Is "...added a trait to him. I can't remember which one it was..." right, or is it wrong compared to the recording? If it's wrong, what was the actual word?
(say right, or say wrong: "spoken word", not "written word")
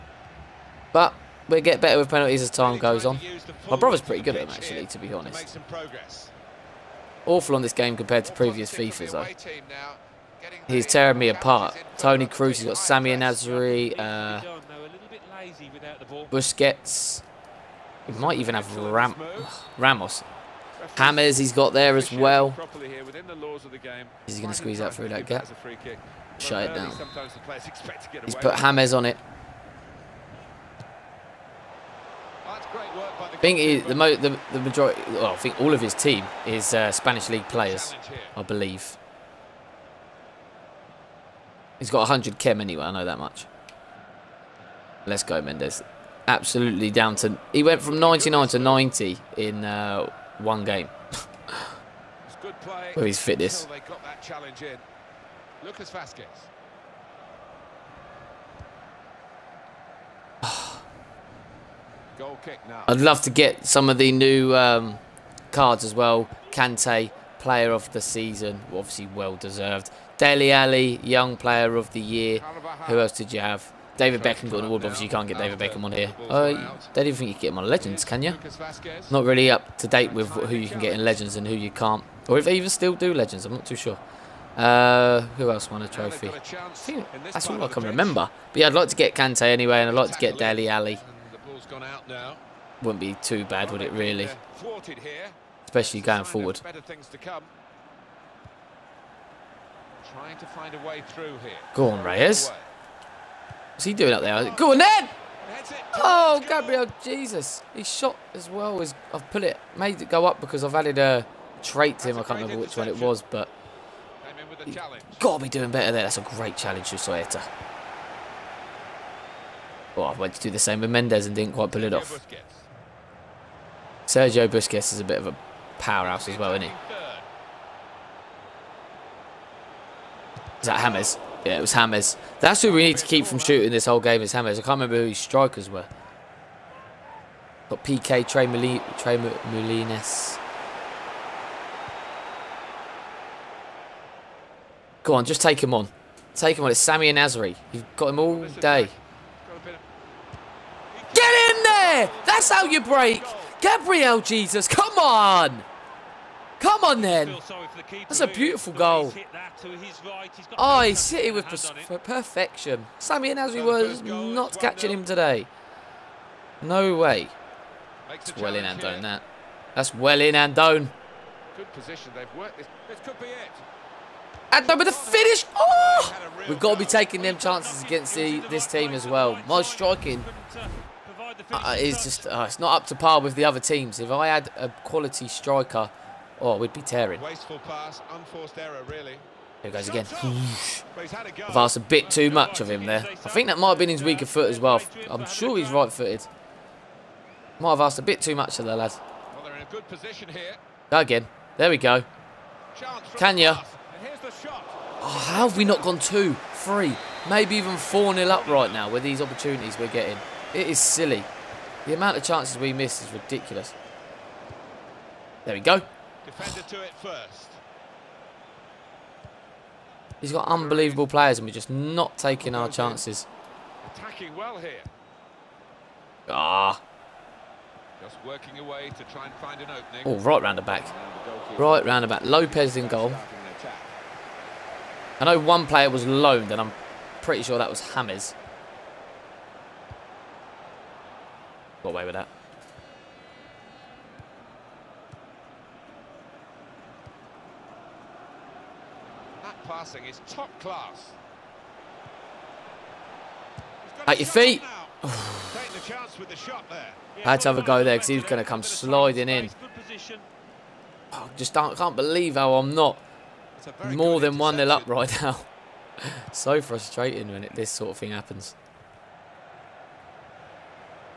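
right.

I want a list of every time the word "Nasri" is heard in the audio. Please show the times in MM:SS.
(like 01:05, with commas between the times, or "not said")
00:13, 02:43.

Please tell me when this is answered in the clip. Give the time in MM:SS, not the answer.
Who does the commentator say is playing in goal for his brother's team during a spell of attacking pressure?
03:52.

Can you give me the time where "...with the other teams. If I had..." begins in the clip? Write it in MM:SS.
03:03.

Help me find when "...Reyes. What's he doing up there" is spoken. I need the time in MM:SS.
01:42.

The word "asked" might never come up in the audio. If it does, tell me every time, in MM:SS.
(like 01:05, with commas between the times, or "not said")
03:11, 03:17.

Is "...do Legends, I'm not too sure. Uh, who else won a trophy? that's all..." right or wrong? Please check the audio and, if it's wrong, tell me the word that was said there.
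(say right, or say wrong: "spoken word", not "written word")
right.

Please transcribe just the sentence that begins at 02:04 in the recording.
Sergio Busquets is a bit of a powerhouse as well, isn't he?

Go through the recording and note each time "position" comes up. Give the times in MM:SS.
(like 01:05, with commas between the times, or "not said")
02:51, 03:19.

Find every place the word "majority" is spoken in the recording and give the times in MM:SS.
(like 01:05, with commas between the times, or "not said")
00:34.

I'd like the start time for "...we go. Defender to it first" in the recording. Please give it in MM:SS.
03:35.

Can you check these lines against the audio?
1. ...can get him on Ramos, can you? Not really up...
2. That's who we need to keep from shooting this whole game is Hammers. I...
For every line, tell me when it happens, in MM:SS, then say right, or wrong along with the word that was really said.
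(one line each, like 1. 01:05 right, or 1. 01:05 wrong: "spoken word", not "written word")
1. 01:17 wrong: "Legends", not "Ramos"
2. 02:12 right.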